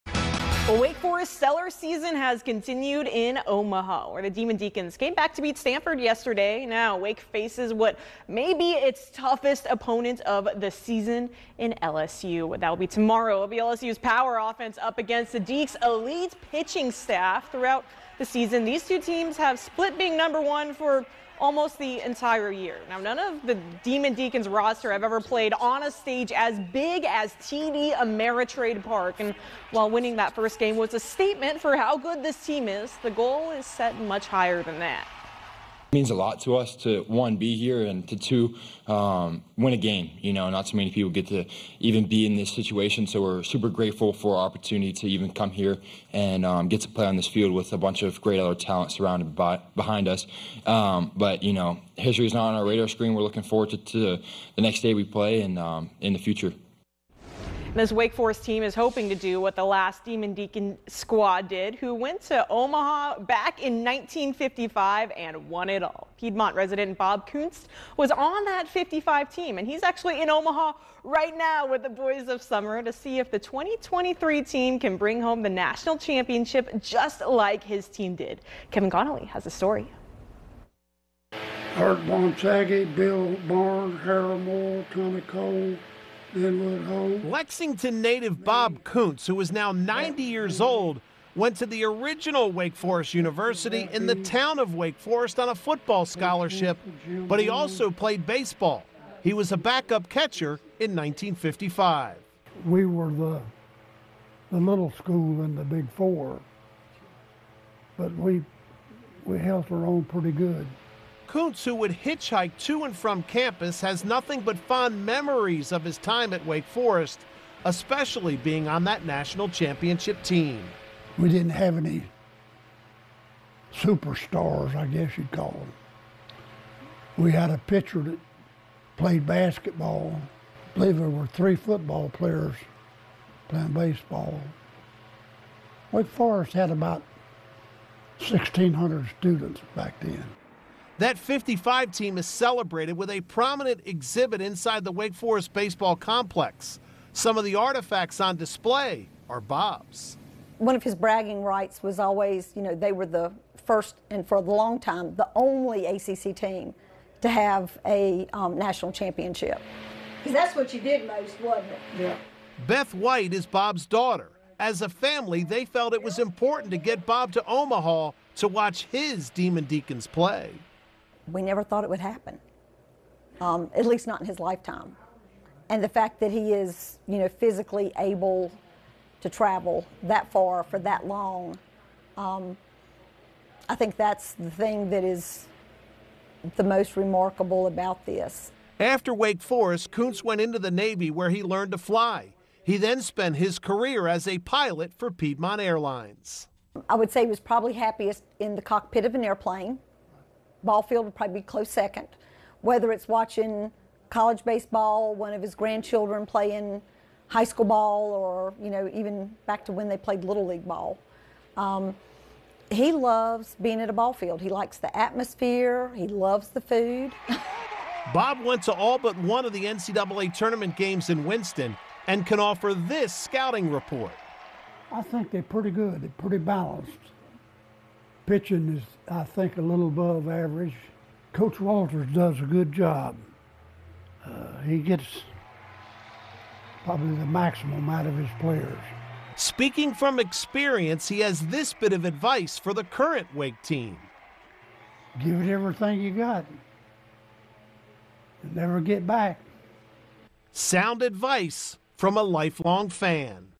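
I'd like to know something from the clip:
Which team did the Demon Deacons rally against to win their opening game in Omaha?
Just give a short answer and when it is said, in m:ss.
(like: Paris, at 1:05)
Stanford, at 0:05.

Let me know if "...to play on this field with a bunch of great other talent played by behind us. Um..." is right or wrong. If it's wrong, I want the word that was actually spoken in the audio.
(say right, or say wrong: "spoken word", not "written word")
wrong: "surrounded", not "played".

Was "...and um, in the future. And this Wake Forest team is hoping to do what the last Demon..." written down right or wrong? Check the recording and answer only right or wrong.
right.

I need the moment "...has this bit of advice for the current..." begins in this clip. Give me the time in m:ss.
4:01.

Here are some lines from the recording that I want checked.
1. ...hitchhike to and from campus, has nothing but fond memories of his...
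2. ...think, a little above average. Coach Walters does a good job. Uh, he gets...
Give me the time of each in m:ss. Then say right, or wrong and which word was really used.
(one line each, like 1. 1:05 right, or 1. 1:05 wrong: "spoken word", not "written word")
1. 1:51 right
2. 3:49 right.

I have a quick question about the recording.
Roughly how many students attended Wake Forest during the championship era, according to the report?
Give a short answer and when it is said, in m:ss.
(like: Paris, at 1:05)
1,600, at 2:18.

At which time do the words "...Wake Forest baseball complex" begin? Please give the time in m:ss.
2:24.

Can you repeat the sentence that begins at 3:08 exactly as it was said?
After Wake Forest, Kuntz went into the Navy where he learned to fly.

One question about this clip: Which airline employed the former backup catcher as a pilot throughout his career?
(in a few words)
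Piedmont Airlines.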